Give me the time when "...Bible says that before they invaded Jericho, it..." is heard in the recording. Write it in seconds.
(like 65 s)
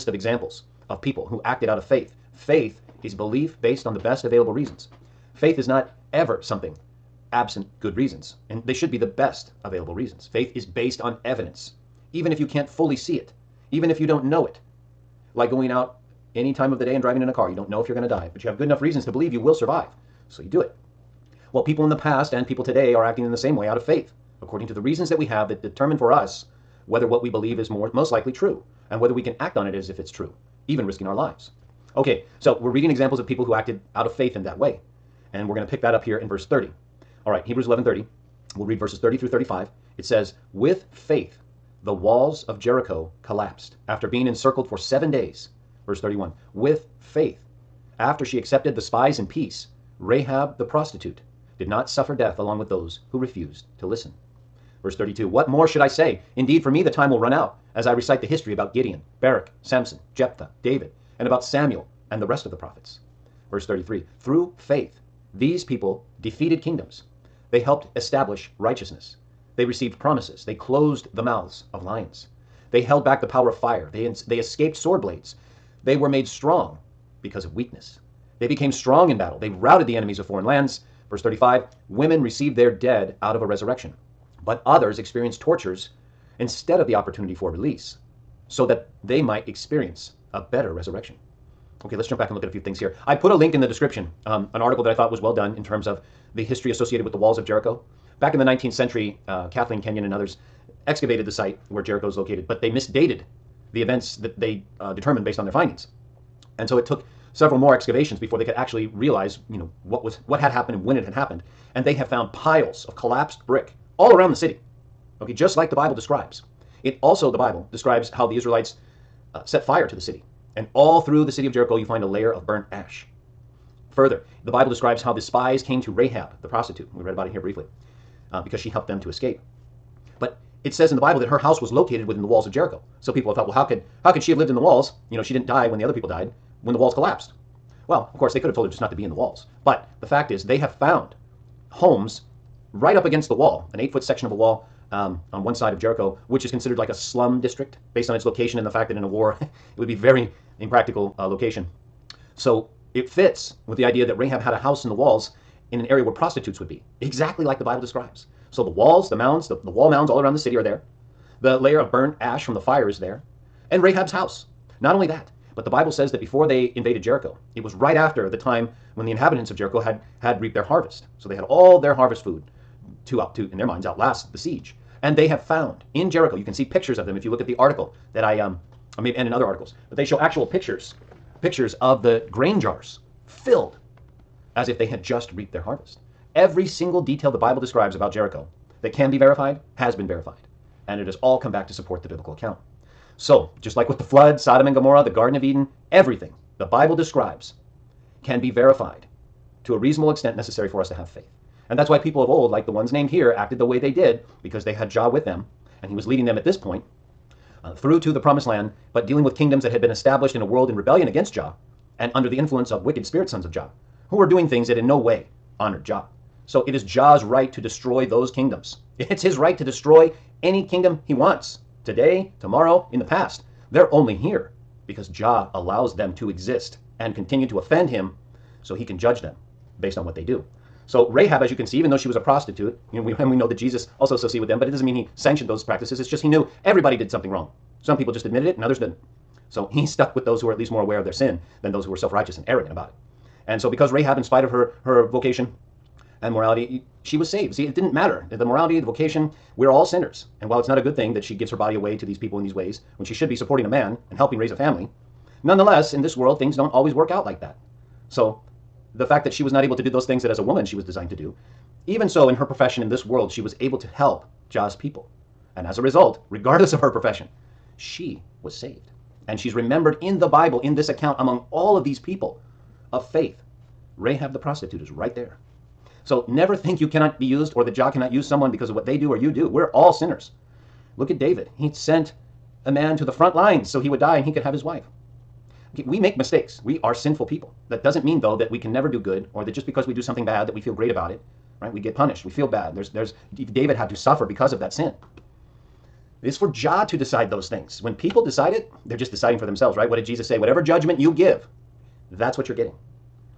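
165 s.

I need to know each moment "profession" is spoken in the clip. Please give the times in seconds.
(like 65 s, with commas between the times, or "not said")
262 s, 266 s.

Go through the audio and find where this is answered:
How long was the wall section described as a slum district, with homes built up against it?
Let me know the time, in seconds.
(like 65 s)
143 s.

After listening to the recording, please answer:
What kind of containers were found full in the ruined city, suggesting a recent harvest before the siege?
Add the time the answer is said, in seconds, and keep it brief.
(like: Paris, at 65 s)
grain jars, at 182 s.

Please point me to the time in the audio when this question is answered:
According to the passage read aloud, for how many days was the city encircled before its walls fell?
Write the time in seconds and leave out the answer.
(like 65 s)
44 s.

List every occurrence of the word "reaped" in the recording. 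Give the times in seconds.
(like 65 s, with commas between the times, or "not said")
170 s, 185 s.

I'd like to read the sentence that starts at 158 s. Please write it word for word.
So the walls, the mounds, the, the wall mounds all around the city are there.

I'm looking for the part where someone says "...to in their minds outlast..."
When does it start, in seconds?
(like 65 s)
173 s.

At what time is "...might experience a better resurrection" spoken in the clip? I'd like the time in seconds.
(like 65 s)
89 s.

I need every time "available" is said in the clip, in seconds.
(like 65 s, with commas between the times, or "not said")
4 s, 9 s.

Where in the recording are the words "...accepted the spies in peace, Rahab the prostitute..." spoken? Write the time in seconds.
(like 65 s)
48 s.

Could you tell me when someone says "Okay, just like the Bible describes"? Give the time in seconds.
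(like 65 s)
115 s.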